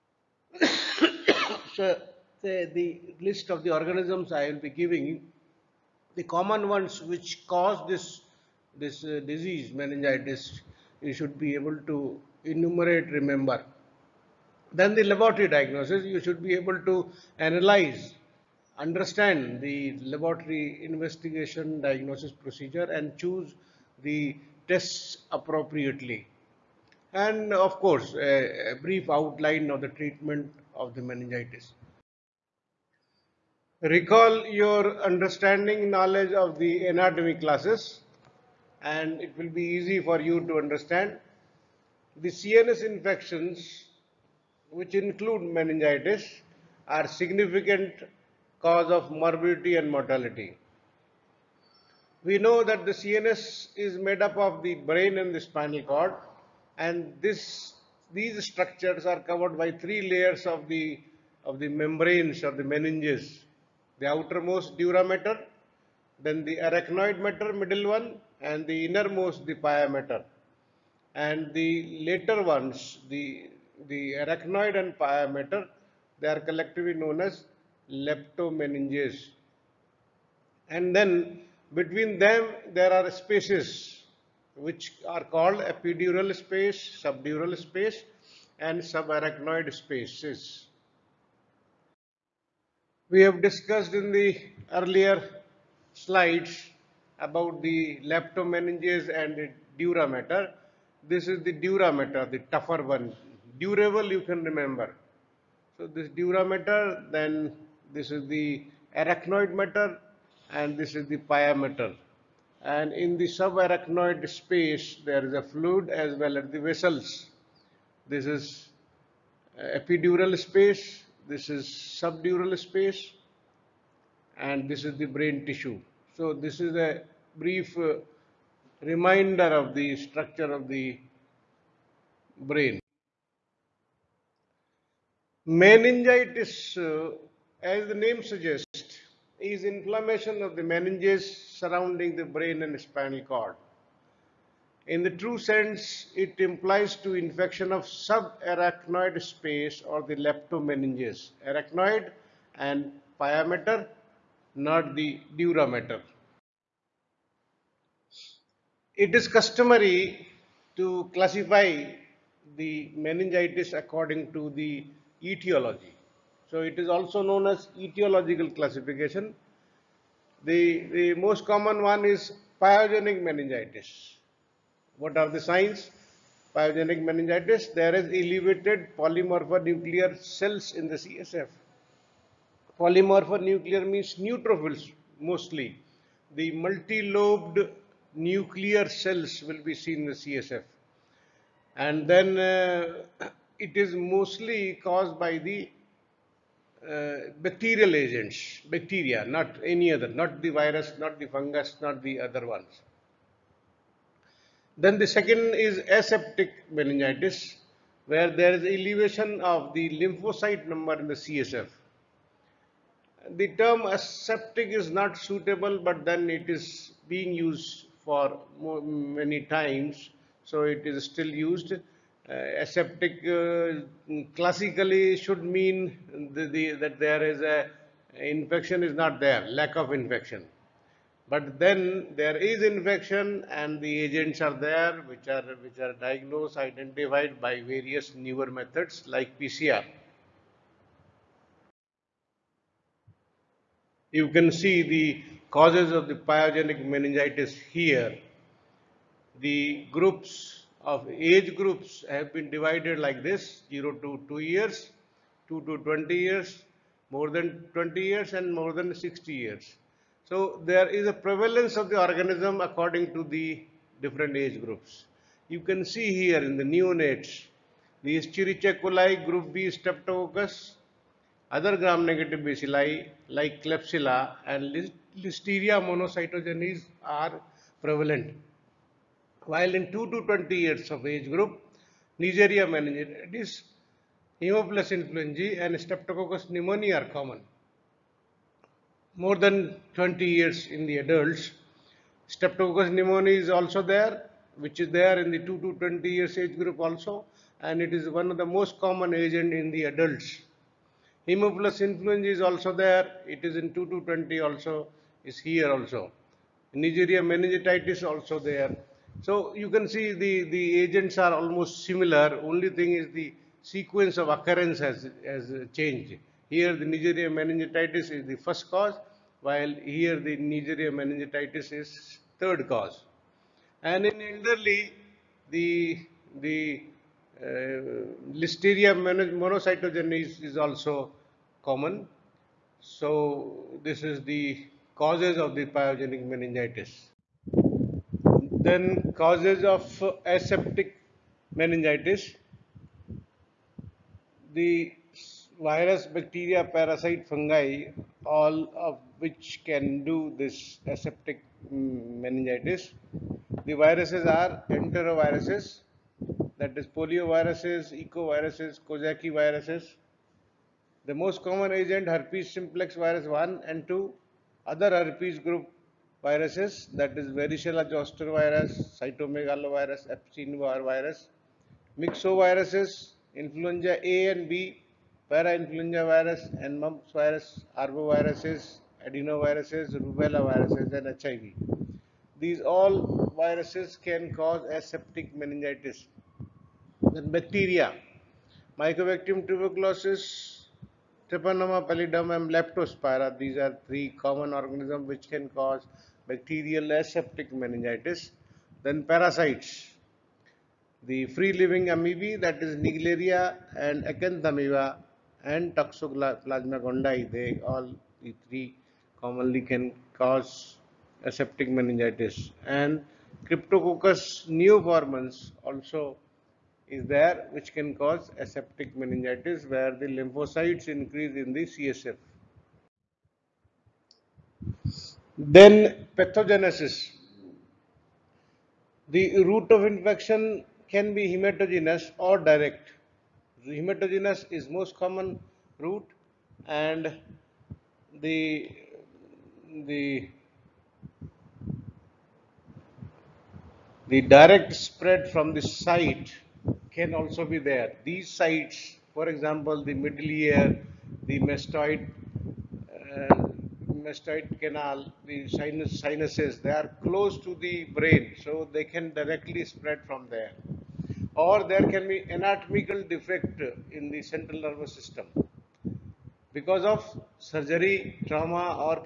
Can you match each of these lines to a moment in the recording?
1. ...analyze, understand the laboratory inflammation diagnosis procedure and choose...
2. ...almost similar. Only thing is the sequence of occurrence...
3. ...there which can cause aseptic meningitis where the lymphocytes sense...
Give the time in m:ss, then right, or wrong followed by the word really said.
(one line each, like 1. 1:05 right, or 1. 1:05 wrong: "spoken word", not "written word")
1. 0:17 wrong: "investigation", not "inflammation"
2. 5:11 right
3. 6:57 wrong: "increase", not "sense".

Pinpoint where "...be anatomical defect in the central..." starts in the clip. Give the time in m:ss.
7:42.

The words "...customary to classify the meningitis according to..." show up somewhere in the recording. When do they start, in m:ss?
2:39.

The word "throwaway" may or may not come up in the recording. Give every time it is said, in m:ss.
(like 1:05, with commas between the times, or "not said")
not said.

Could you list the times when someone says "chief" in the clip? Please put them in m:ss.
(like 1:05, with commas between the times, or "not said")
not said.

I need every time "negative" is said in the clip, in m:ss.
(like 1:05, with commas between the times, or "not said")
4:31.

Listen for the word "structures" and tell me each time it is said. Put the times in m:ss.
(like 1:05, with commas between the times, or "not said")
0:58, 2:09.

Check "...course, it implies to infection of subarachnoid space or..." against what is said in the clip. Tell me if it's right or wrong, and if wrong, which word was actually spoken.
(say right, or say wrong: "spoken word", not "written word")
wrong: "sense", not "course".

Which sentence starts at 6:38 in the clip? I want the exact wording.
Then parasites, the free-living amoebae that is Naegleria and Acanthamoeba and Toxoplasma gondii, they all the three commonly can cause aseptic meningitis.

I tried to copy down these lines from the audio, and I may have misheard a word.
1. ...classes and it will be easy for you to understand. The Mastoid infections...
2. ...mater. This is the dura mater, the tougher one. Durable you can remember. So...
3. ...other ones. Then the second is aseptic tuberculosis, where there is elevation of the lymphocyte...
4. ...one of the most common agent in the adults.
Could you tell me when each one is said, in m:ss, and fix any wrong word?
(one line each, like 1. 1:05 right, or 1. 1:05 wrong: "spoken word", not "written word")
1. 0:37 wrong: "CNS", not "Mastoid"
2. 1:40 right
3. 3:22 wrong: "meningitis", not "tuberculosis"
4. 4:58 right.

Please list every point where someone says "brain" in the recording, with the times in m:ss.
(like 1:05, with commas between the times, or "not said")
0:54, 2:05, 2:12, 2:22, 7:37.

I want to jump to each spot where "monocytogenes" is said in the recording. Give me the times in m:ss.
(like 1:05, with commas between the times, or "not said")
4:35, 5:28.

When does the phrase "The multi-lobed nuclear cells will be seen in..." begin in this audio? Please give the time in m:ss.
3:06.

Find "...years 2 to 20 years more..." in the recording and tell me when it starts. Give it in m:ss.
4:14.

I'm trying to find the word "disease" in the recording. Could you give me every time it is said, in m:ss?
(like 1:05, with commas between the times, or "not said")
0:09.